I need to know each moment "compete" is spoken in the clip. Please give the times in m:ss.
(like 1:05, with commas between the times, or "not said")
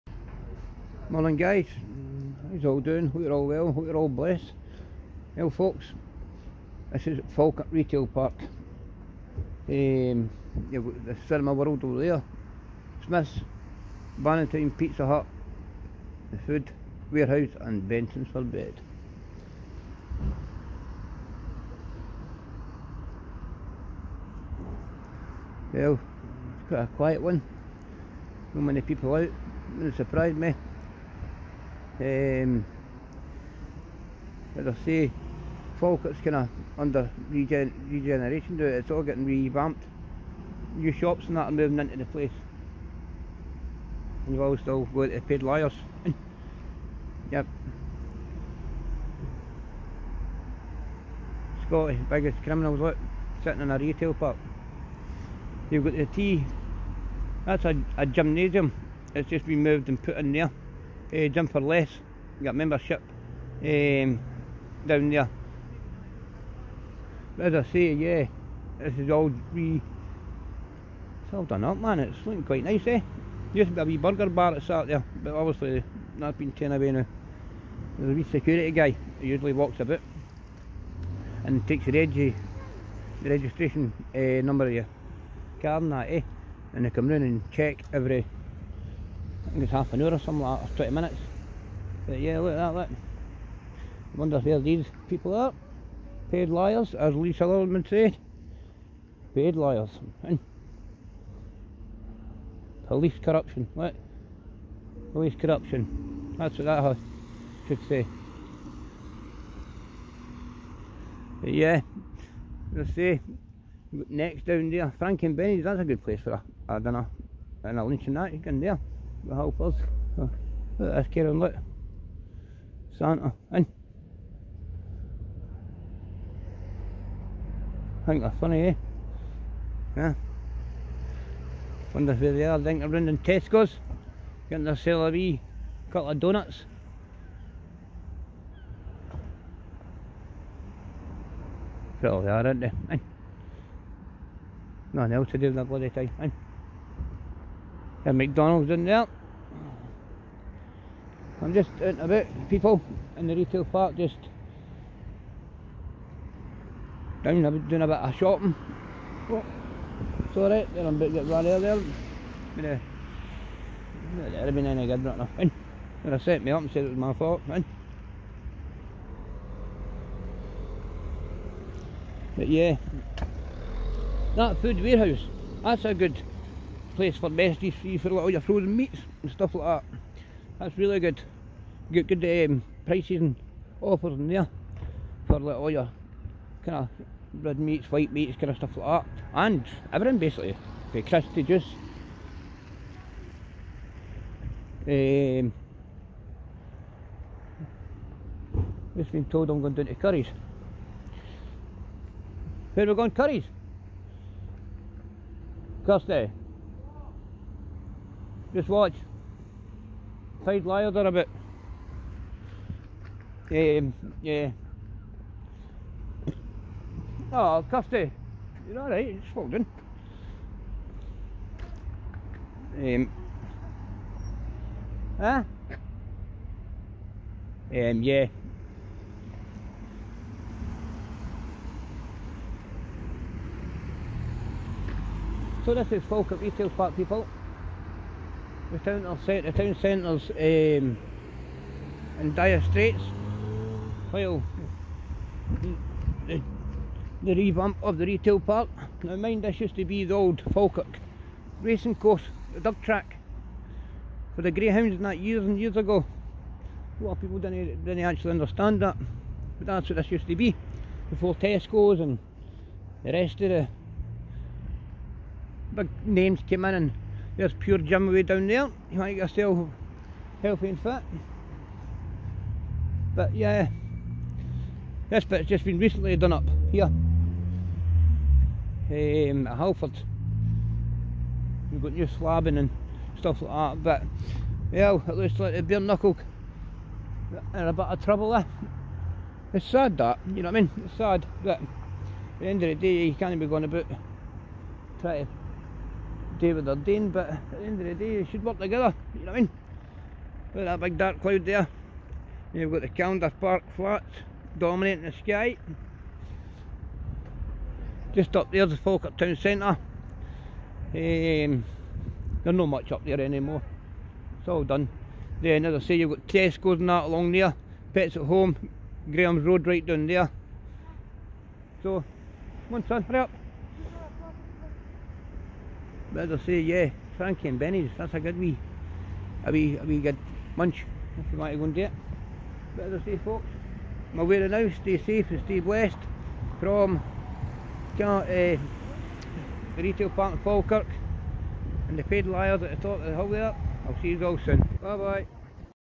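not said.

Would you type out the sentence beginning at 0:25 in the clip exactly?
Well, it's quite a quiet one.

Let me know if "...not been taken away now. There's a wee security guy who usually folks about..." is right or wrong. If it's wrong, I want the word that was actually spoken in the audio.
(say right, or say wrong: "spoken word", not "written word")
wrong: "walks", not "folks".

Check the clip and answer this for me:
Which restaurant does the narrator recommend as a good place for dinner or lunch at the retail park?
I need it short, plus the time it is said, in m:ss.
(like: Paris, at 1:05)
Frank and Benny's, at 1:54.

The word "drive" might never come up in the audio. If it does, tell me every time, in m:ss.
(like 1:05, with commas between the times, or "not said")
not said.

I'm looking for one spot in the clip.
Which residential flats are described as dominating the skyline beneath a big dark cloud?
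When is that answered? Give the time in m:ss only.
5:02.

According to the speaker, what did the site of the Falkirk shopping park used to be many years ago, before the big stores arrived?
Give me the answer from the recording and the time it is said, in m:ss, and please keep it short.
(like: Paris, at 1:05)
Falkirk racing course, at 4:10.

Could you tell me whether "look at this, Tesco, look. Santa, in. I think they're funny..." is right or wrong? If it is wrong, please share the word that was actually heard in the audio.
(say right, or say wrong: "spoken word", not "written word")
wrong: "Karen", not "Tesco".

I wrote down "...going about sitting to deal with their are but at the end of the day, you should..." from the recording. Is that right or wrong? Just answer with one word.
wrong.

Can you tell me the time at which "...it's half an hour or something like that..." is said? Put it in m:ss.
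1:29.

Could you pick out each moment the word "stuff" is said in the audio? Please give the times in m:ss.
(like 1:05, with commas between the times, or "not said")
2:59, 3:08, 4:43.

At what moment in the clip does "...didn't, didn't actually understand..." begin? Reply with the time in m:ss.
4:17.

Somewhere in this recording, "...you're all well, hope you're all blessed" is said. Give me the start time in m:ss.
0:03.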